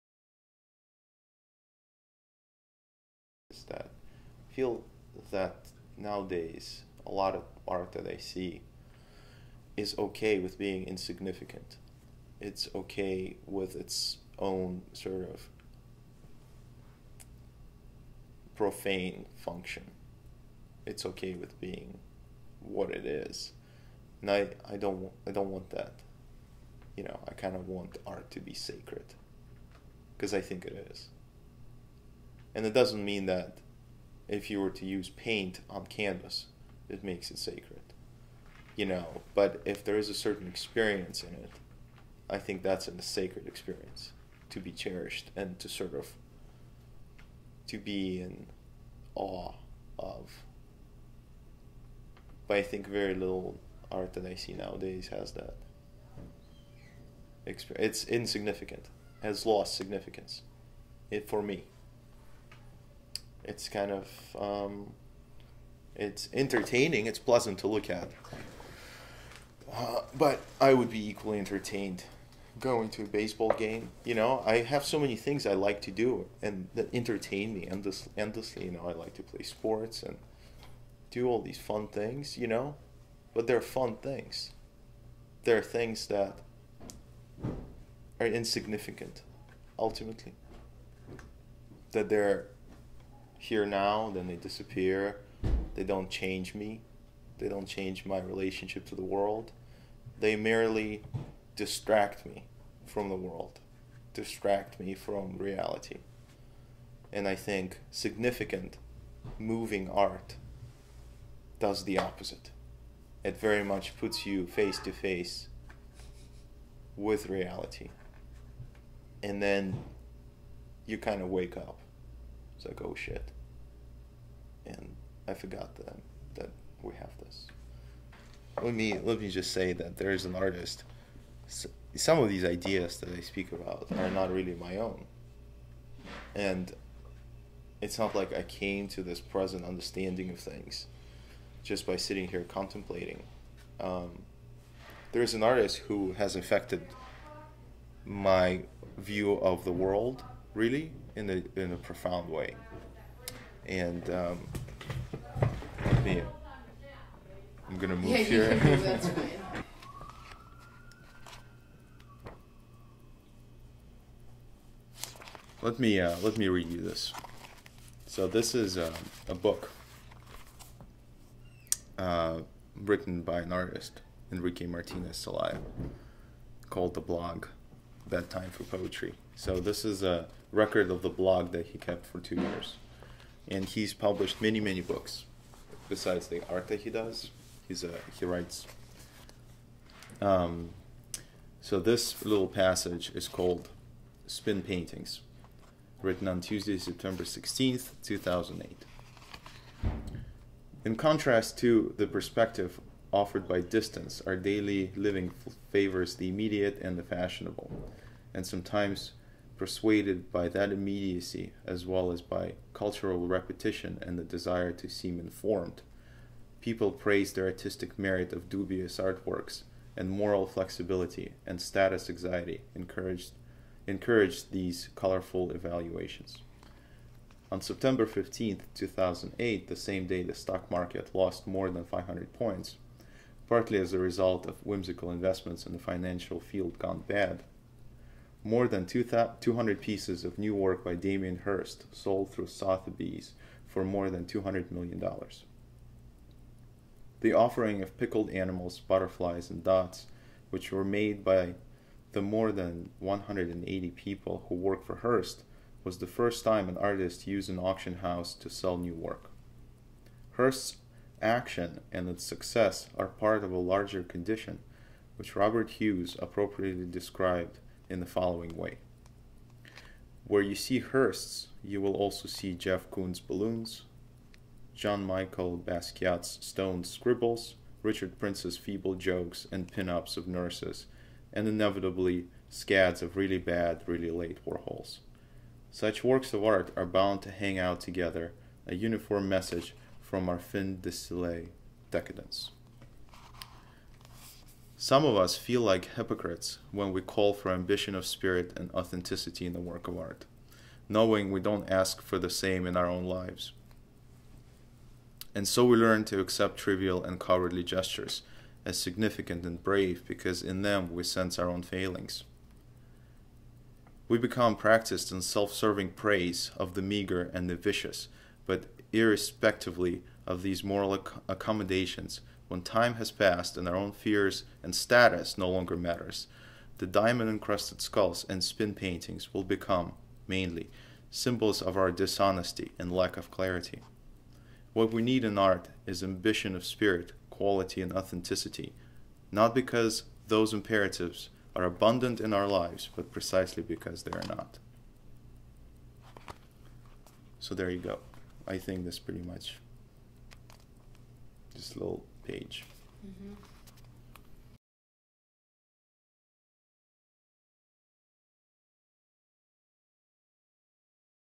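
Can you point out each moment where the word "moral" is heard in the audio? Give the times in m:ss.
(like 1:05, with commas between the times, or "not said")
3:40, 5:20.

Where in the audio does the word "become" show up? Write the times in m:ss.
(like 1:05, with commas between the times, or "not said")
5:14, 5:29.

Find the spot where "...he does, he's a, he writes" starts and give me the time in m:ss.
3:06.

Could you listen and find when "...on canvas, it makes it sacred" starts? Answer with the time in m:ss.
0:35.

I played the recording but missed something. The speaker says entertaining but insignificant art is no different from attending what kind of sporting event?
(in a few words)
baseball game.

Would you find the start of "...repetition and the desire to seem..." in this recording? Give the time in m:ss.
3:33.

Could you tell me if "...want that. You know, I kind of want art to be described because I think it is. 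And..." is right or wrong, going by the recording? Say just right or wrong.
wrong.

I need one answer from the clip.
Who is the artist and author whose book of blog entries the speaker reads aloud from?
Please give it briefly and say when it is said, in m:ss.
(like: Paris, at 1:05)
Enrique Martinez Celaya, at 2:54.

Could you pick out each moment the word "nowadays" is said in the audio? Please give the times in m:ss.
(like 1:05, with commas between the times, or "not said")
0:05, 0:54.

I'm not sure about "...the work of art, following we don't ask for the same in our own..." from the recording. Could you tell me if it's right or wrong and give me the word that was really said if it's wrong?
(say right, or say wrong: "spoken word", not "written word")
wrong: "knowing", not "following".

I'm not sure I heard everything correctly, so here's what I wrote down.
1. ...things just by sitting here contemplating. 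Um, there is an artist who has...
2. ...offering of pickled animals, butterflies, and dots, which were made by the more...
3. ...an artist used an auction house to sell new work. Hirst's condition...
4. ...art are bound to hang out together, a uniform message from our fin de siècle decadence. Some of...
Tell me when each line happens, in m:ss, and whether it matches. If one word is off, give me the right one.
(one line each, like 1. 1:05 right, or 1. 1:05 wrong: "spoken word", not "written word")
1. 2:20 right
2. 4:07 right
3. 4:16 wrong: "action", not "condition"
4. 4:46 right.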